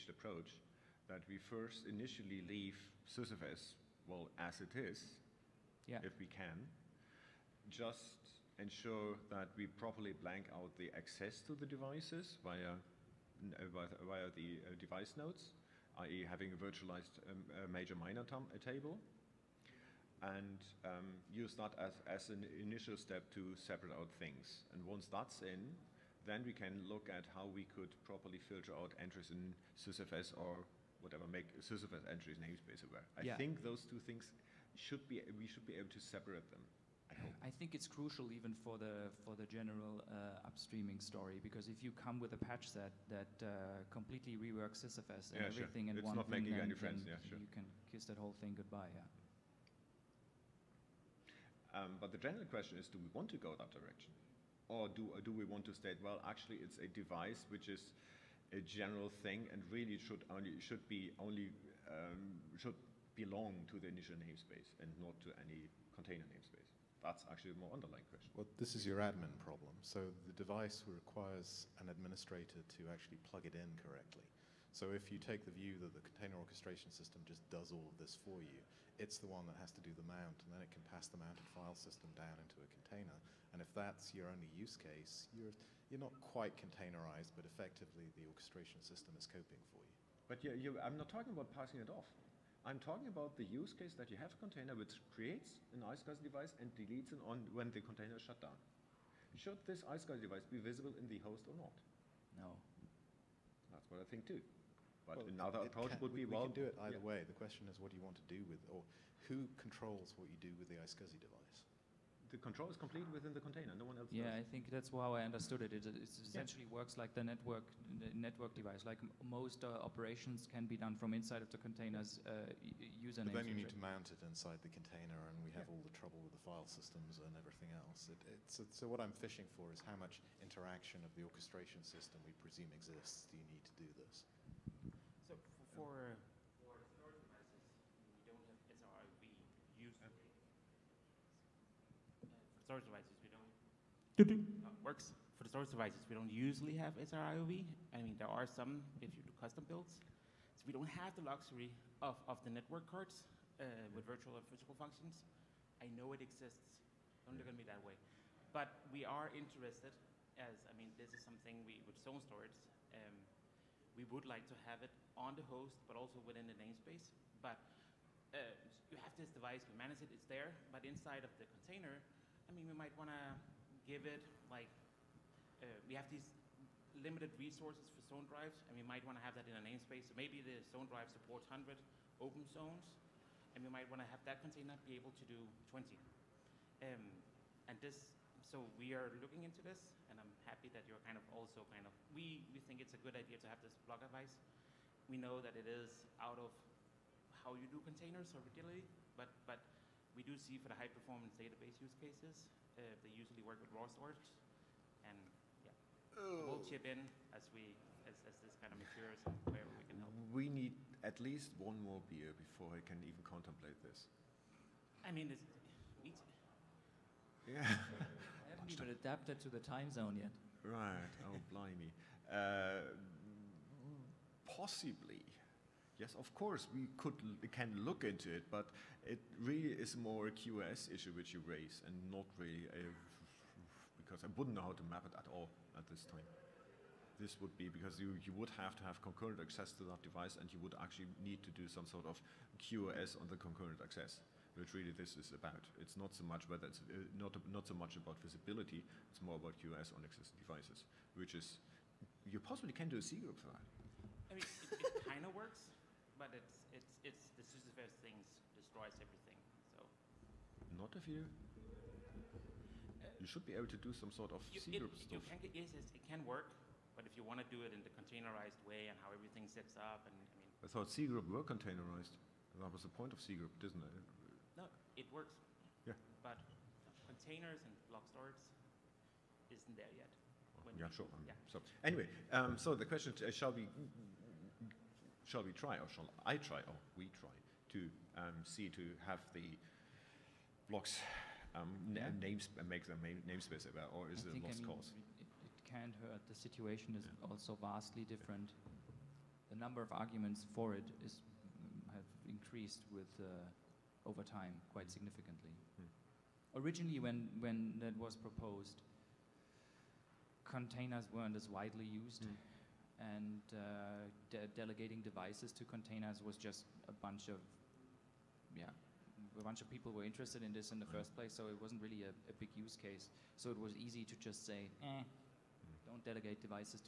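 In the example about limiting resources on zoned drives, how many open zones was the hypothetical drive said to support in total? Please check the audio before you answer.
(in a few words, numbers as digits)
100.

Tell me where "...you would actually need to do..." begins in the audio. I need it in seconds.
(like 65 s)
240 s.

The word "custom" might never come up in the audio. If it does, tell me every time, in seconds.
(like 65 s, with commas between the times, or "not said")
149 s.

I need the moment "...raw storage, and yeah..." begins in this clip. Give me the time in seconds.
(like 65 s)
203 s.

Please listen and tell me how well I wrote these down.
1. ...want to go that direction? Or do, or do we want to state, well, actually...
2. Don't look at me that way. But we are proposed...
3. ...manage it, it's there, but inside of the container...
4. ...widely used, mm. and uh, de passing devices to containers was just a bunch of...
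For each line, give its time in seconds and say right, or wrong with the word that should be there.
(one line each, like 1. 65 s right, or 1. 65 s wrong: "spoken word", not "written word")
1. 53 s right
2. 157 s wrong: "interested", not "proposed"
3. 169 s right
4. 311 s wrong: "delegating", not "passing".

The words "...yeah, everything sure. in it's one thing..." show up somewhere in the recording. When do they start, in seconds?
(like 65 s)
45 s.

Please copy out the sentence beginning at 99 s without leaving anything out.
Should this iSCSI device be visible in the host or not?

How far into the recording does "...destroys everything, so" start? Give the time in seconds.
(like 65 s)
258 s.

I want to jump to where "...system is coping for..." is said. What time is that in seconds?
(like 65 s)
88 s.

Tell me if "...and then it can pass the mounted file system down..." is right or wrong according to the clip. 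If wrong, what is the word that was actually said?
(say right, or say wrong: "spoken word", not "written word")
right.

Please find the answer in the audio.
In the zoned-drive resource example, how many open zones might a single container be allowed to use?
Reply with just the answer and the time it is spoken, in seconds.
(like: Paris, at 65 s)
20, at 185 s.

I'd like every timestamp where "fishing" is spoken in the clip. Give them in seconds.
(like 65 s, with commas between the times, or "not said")
129 s.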